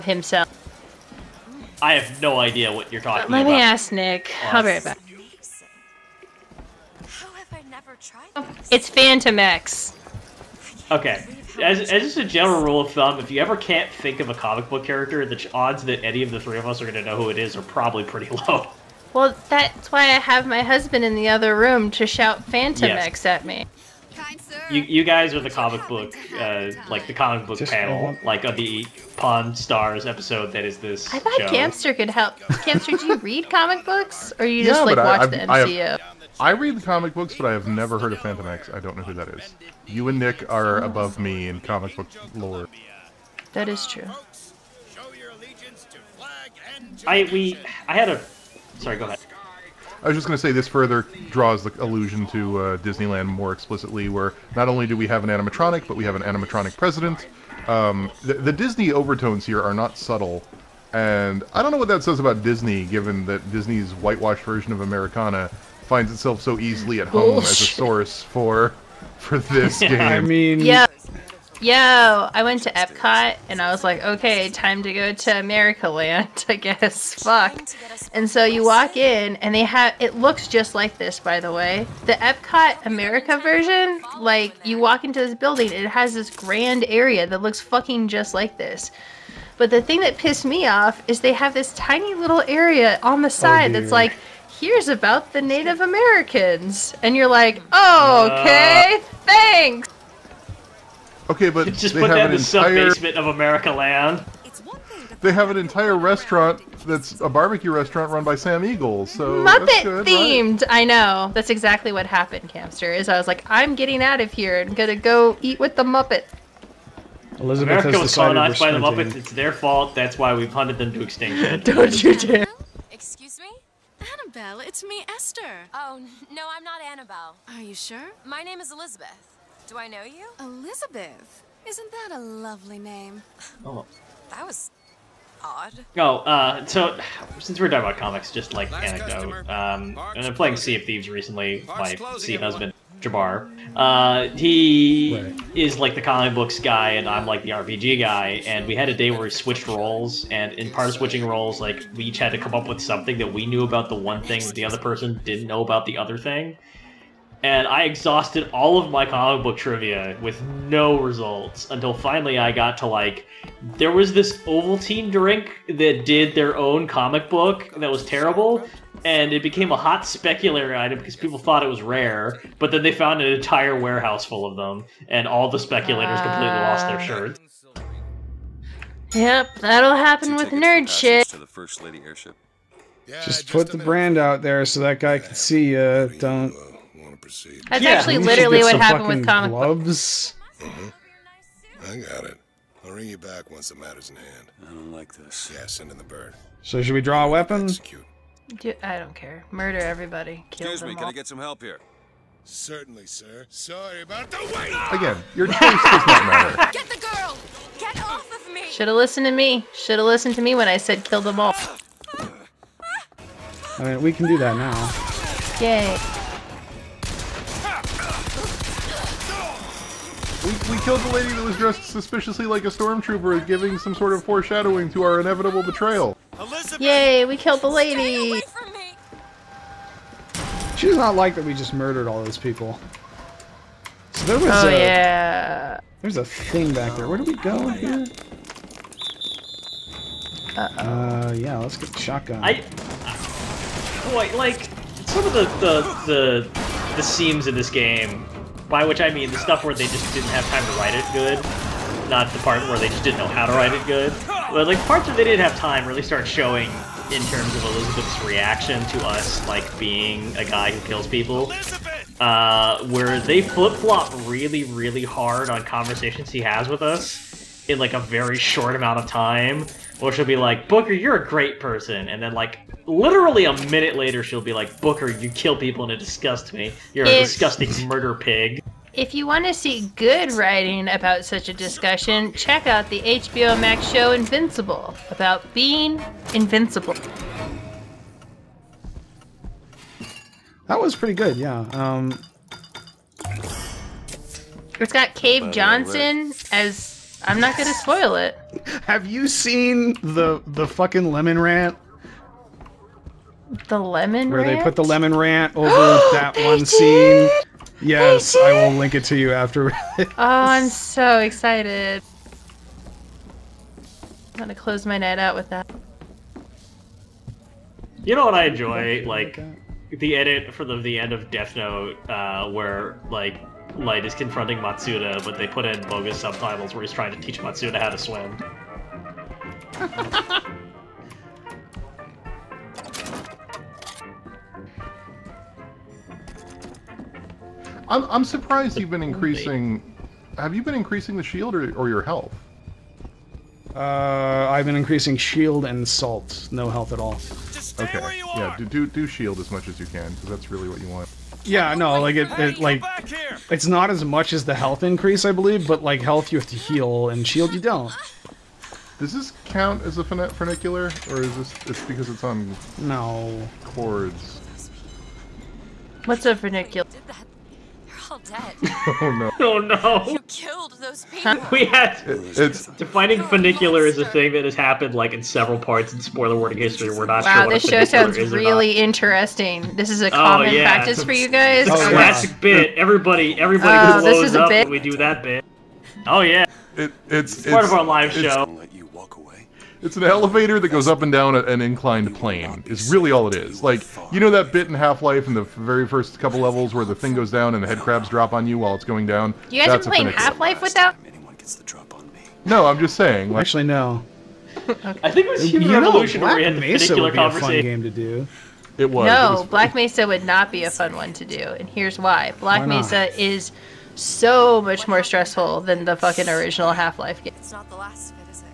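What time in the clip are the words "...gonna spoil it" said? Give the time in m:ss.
4:57.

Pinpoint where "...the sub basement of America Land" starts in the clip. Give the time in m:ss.
1:42.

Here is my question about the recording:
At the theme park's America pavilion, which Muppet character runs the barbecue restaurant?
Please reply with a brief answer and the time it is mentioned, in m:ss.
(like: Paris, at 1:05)
Sam Eagle, at 1:48.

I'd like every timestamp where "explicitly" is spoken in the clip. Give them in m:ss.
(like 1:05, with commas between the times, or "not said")
0:53.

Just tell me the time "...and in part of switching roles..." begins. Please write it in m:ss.
2:30.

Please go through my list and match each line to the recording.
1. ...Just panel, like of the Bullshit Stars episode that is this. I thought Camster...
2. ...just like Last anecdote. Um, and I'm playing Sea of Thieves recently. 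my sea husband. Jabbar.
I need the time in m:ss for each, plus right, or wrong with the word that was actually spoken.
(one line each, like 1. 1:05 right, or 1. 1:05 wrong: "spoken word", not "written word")
1. 0:27 wrong: "Pawn", not "Bullshit"
2. 2:18 right.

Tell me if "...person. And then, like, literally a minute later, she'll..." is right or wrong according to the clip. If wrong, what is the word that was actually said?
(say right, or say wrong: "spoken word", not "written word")
right.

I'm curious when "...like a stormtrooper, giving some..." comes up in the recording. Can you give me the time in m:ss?
3:42.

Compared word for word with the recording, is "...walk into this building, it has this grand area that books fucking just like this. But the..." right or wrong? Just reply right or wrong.
wrong.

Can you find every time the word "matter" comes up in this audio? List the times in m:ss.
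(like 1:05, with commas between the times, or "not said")
3:13, 3:26.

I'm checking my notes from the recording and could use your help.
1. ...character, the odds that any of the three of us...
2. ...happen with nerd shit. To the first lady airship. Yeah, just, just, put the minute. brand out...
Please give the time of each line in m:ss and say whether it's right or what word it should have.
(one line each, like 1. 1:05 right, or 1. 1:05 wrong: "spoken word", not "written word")
1. 0:14 right
2. 2:59 right.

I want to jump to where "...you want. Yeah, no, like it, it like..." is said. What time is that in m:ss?
5:50.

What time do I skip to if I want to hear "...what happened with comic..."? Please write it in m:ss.
3:08.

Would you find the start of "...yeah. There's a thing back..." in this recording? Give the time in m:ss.
3:54.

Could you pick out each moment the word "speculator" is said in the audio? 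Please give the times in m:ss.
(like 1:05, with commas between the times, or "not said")
2:50, 2:55.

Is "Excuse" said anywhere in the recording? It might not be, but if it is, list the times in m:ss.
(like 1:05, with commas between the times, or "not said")
2:02, 3:20.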